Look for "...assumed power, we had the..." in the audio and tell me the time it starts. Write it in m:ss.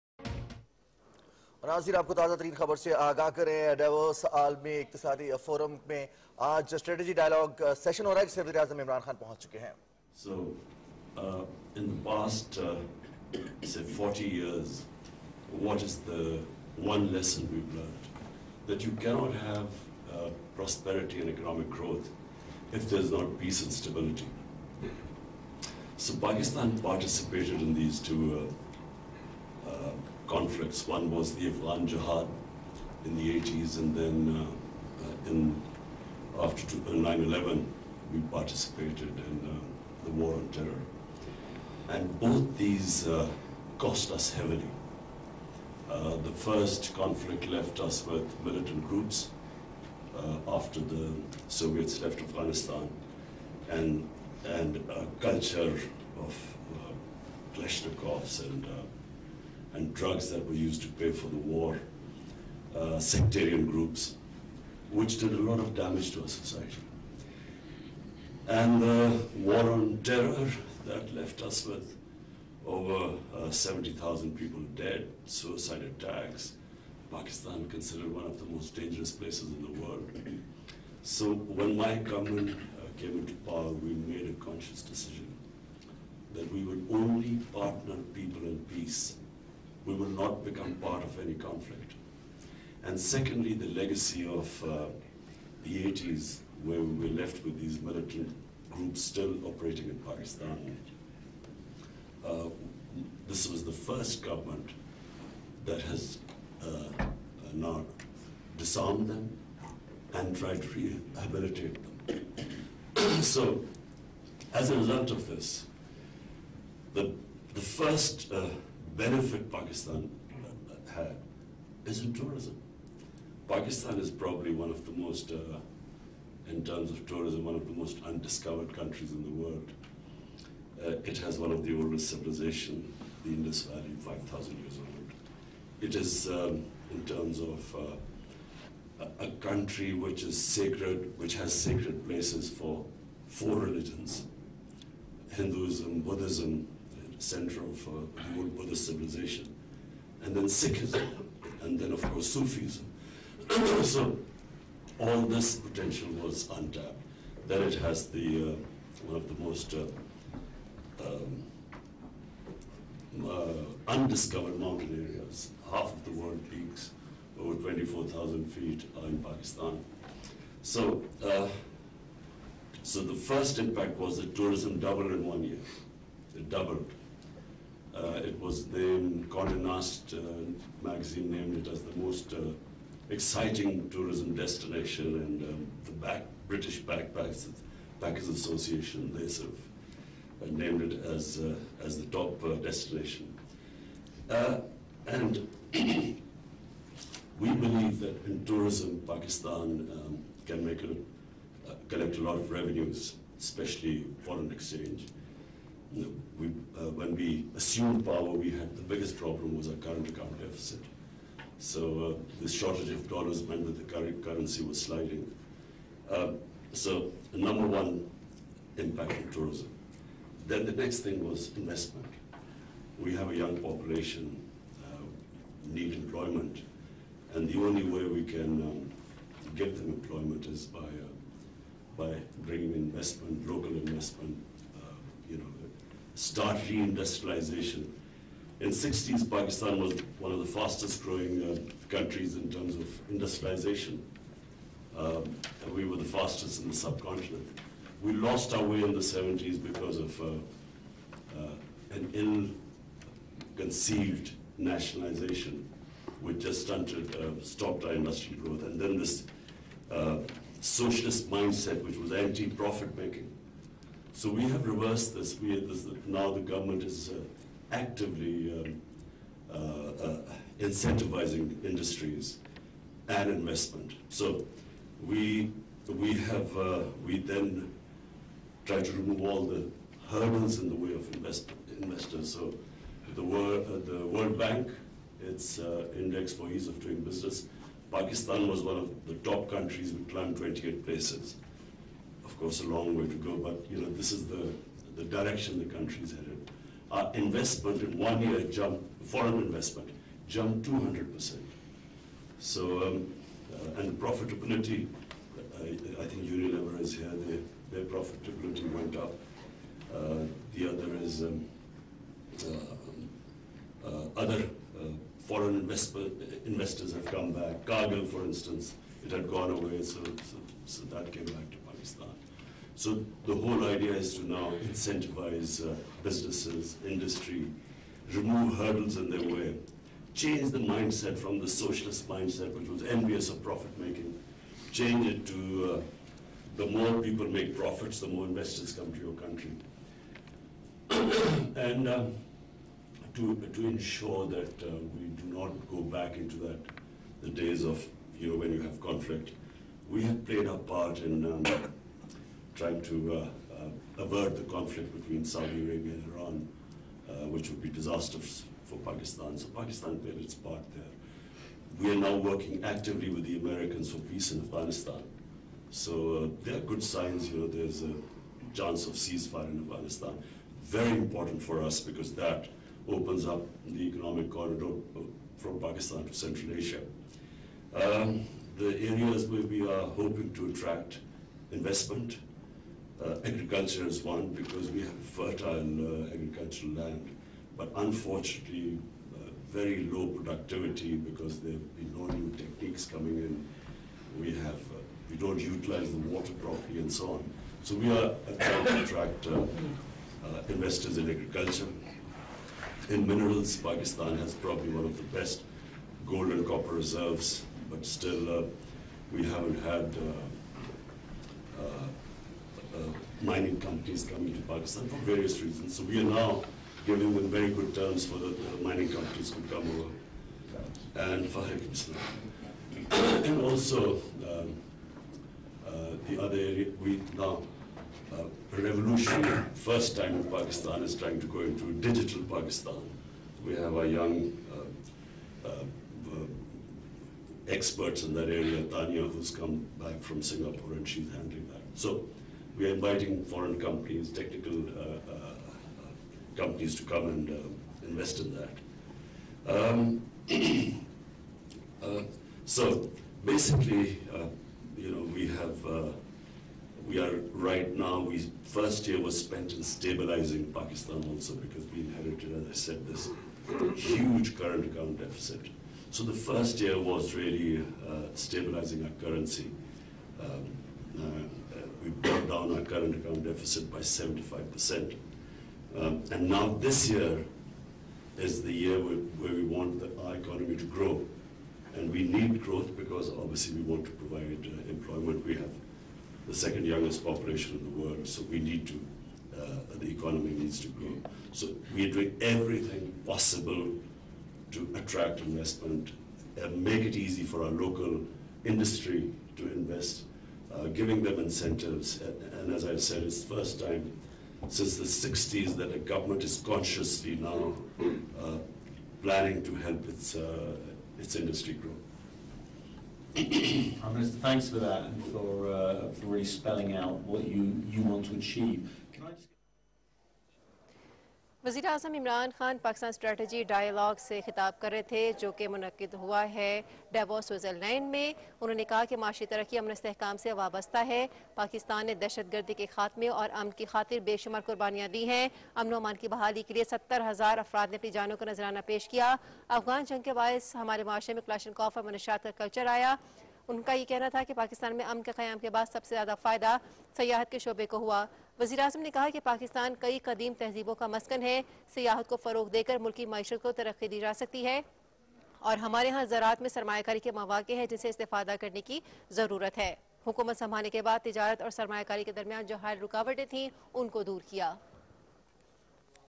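3:27.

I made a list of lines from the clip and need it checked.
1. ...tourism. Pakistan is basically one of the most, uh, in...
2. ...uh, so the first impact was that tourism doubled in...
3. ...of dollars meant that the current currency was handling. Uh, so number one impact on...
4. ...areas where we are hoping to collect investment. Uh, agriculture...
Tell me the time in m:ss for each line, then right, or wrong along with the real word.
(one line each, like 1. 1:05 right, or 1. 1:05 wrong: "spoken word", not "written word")
1. 2:02 wrong: "probably", not "basically"
2. 2:51 right
3. 3:32 wrong: "sliding", not "handling"
4. 6:18 wrong: "attract", not "collect".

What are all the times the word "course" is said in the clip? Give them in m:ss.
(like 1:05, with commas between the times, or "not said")
2:32, 4:52.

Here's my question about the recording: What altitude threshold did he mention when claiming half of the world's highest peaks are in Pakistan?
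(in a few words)
24,000 feet.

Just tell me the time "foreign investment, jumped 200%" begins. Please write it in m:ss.
4:59.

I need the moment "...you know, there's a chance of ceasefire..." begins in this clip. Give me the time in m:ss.
6:07.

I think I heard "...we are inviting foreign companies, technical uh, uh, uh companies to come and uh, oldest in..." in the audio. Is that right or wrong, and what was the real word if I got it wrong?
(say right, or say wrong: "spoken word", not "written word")
wrong: "invest", not "oldest".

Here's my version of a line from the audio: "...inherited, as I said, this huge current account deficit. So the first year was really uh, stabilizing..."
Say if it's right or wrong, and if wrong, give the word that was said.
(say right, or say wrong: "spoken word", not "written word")
right.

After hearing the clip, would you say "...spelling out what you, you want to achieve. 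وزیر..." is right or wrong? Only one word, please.
right.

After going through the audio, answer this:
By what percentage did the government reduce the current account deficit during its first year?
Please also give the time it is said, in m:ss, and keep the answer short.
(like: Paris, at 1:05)
75%, at 7:53.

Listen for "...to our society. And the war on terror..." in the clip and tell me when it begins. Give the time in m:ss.
1:06.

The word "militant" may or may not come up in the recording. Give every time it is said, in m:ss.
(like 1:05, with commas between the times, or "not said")
0:48, 1:37.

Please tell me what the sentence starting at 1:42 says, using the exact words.
Uh, this was the first government that has uh, uh disarmed them and tried to rehabilitate them.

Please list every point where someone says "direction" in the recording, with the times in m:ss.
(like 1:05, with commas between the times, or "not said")
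4:55.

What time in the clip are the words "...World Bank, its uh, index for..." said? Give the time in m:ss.
4:44.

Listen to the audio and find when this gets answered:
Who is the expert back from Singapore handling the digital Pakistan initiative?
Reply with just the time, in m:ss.
7:18.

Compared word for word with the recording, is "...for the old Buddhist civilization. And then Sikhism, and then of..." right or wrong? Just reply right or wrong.
right.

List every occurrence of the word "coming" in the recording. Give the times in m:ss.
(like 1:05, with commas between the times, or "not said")
6:32, 6:54.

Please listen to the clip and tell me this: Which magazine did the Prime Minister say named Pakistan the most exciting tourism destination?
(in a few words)
Condé Nast.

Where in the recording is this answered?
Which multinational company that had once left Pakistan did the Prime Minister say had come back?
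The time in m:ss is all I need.
5:17.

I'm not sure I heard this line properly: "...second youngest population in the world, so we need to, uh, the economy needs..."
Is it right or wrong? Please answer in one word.
right.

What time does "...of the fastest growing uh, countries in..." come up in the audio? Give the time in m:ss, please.
4:00.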